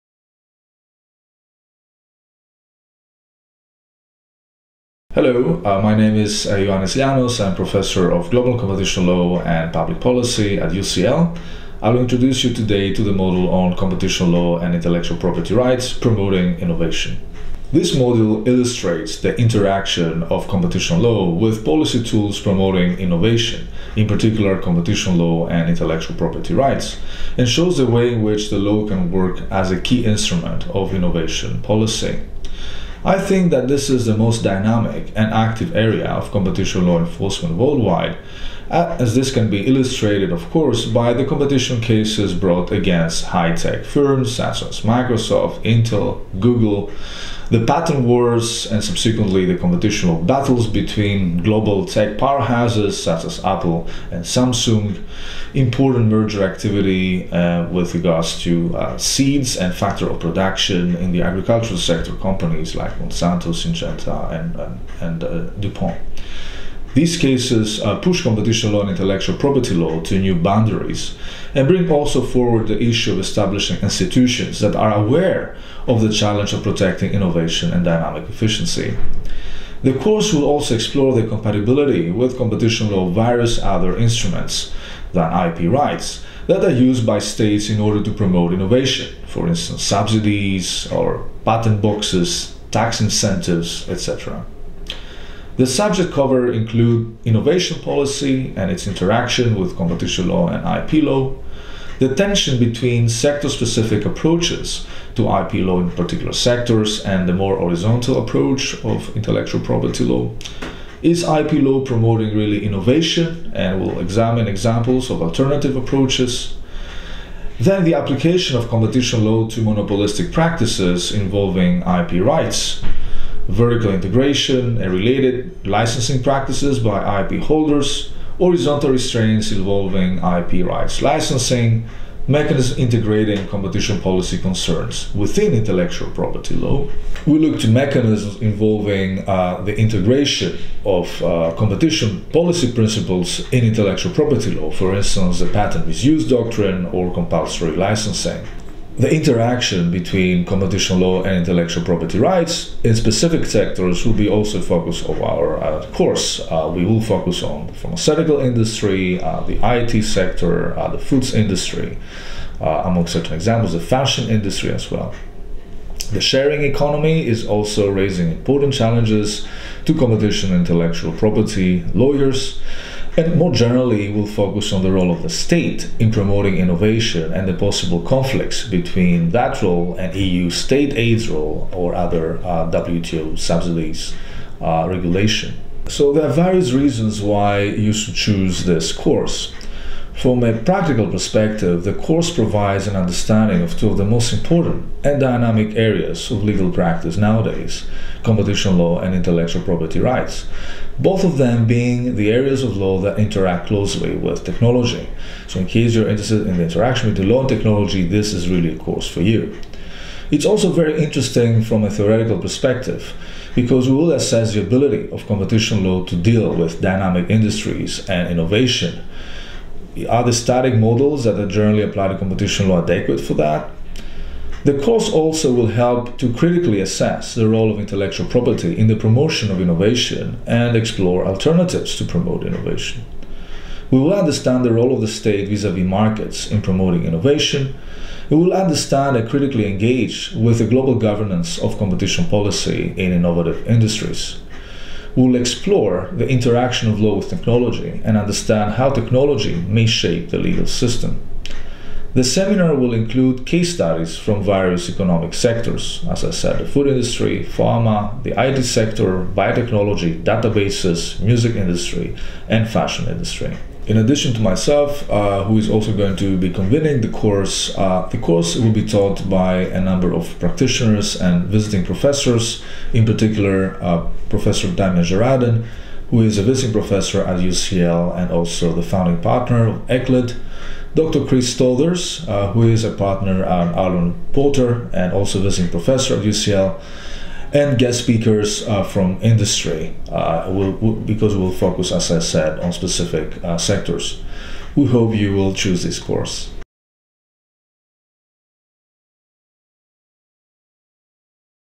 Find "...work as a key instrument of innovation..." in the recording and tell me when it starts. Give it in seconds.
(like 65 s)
29 s.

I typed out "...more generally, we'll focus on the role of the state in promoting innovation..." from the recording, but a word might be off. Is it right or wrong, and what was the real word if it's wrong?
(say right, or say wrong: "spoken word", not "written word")
right.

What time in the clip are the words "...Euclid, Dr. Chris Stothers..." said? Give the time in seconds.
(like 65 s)
279 s.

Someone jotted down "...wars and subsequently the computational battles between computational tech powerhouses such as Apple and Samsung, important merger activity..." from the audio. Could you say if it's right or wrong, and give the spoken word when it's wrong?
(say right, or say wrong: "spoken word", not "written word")
wrong: "global", not "computational".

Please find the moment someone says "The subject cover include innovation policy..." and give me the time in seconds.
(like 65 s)
95 s.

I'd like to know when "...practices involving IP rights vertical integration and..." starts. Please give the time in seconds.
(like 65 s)
120 s.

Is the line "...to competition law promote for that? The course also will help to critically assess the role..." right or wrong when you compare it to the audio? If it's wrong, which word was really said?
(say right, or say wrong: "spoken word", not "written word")
wrong: "adequate", not "promote".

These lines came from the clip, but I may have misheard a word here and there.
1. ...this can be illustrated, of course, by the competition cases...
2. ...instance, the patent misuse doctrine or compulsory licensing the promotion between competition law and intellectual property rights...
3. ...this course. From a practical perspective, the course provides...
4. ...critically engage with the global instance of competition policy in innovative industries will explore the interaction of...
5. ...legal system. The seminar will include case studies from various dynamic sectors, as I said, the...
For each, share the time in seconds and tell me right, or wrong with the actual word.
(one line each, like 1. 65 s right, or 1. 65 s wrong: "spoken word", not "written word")
1. 39 s right
2. 144 s wrong: "interaction", not "promotion"
3. 188 s right
4. 239 s wrong: "governance", not "instance"
5. 250 s wrong: "economic", not "dynamic".